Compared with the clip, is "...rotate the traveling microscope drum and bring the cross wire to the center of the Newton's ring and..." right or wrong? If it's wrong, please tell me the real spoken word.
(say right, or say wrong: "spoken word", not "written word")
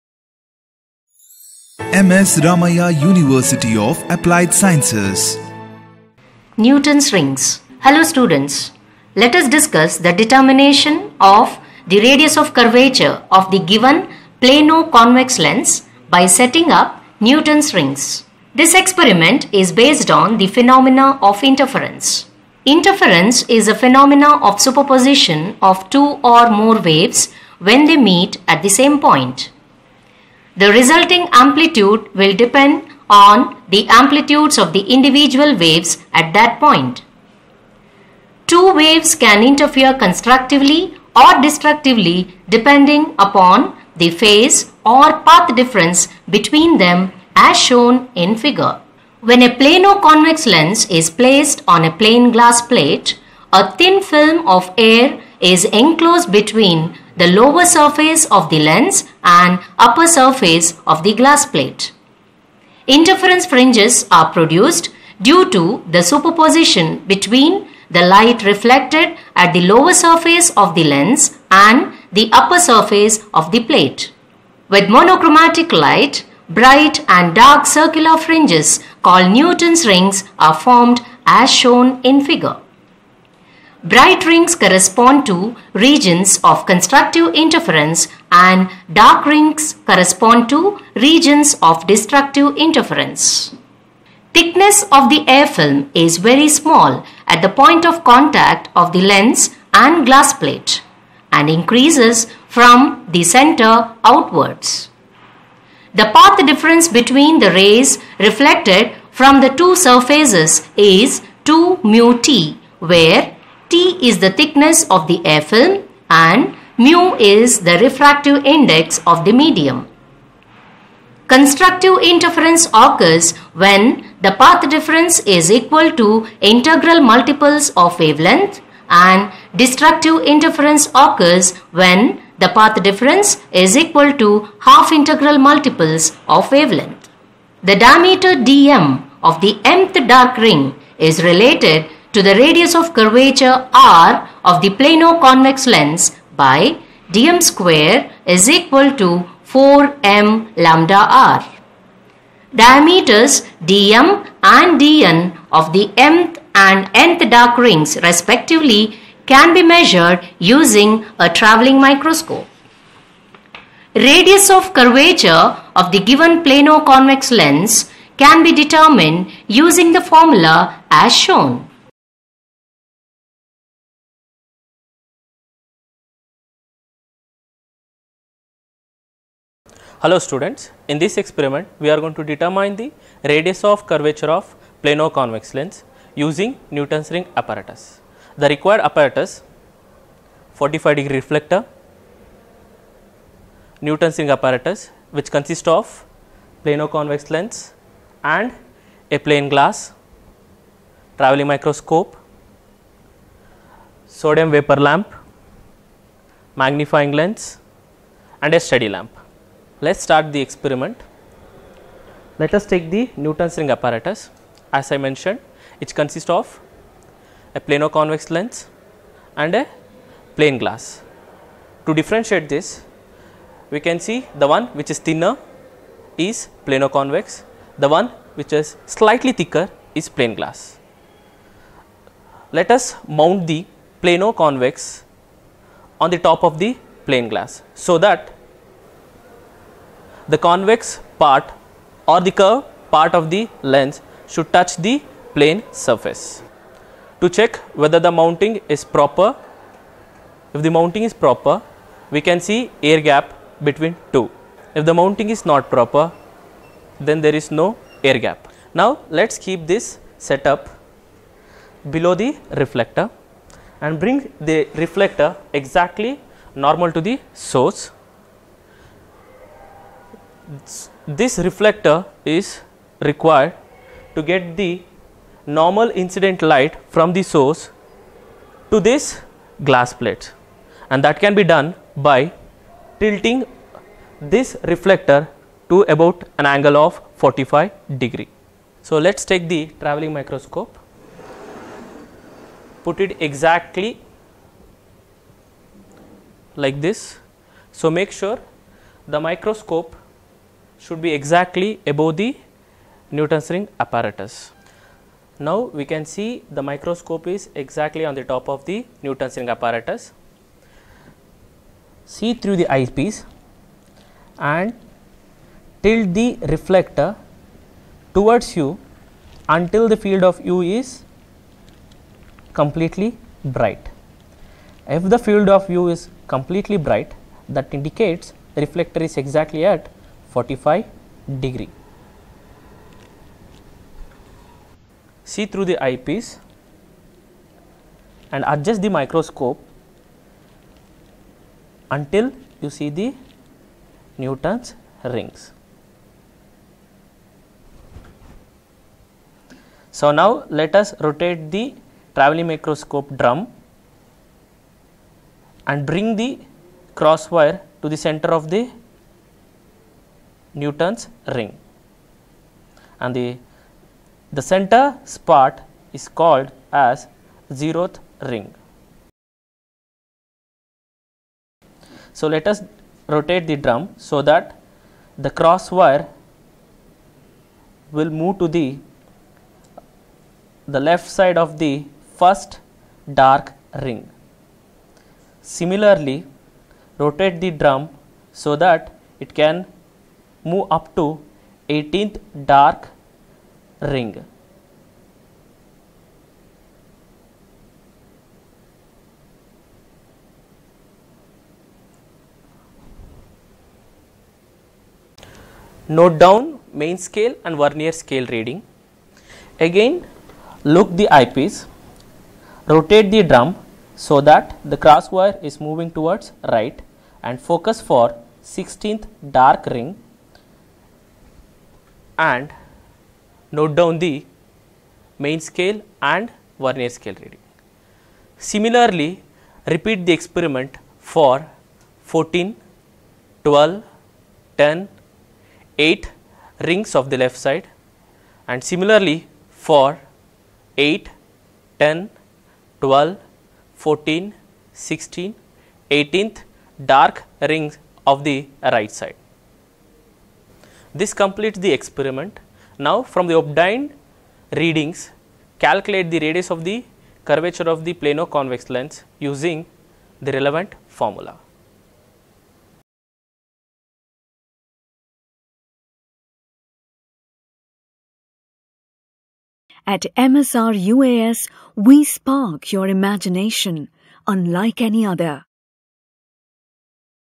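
right.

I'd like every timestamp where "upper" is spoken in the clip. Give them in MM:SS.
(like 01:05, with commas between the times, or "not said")
00:59, 01:12.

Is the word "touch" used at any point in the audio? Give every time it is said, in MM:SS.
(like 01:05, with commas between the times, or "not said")
04:04.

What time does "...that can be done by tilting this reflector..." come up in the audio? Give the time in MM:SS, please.
04:41.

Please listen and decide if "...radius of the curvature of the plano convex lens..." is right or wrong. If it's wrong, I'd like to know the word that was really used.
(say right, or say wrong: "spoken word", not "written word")
right.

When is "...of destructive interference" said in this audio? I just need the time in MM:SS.
01:31.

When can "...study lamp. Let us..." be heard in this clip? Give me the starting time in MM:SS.
03:28.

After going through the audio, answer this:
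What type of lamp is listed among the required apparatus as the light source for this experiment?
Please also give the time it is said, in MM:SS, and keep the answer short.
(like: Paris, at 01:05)
Sodium vapor lamp, at 03:24.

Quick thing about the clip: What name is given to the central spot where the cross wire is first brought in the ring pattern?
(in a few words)
Zeroth ring.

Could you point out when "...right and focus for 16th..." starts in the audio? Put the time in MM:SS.
06:56.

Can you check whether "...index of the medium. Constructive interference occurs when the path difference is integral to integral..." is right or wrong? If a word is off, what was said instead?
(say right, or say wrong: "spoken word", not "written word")
wrong: "equal", not "integral".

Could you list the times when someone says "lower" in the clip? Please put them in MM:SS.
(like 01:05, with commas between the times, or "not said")
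00:57, 01:09.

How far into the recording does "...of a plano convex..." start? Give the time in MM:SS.
03:36.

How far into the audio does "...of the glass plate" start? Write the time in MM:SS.
01:00.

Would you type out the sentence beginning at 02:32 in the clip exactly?
Diameters dm and dn of the mth and nth dark rings respectively can be measured using a traveling microscope.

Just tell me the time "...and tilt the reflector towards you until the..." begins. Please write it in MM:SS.
05:14.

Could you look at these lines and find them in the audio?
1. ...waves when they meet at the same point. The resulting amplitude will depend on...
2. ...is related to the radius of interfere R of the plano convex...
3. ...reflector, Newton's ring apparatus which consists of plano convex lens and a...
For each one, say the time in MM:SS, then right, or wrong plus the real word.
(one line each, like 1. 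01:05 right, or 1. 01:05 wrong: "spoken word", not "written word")
1. 00:26 right
2. 02:20 wrong: "curvature", not "interfere"
3. 03:11 right.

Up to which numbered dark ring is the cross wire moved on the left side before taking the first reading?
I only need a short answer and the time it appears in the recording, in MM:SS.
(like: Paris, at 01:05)
18th, at 06:31.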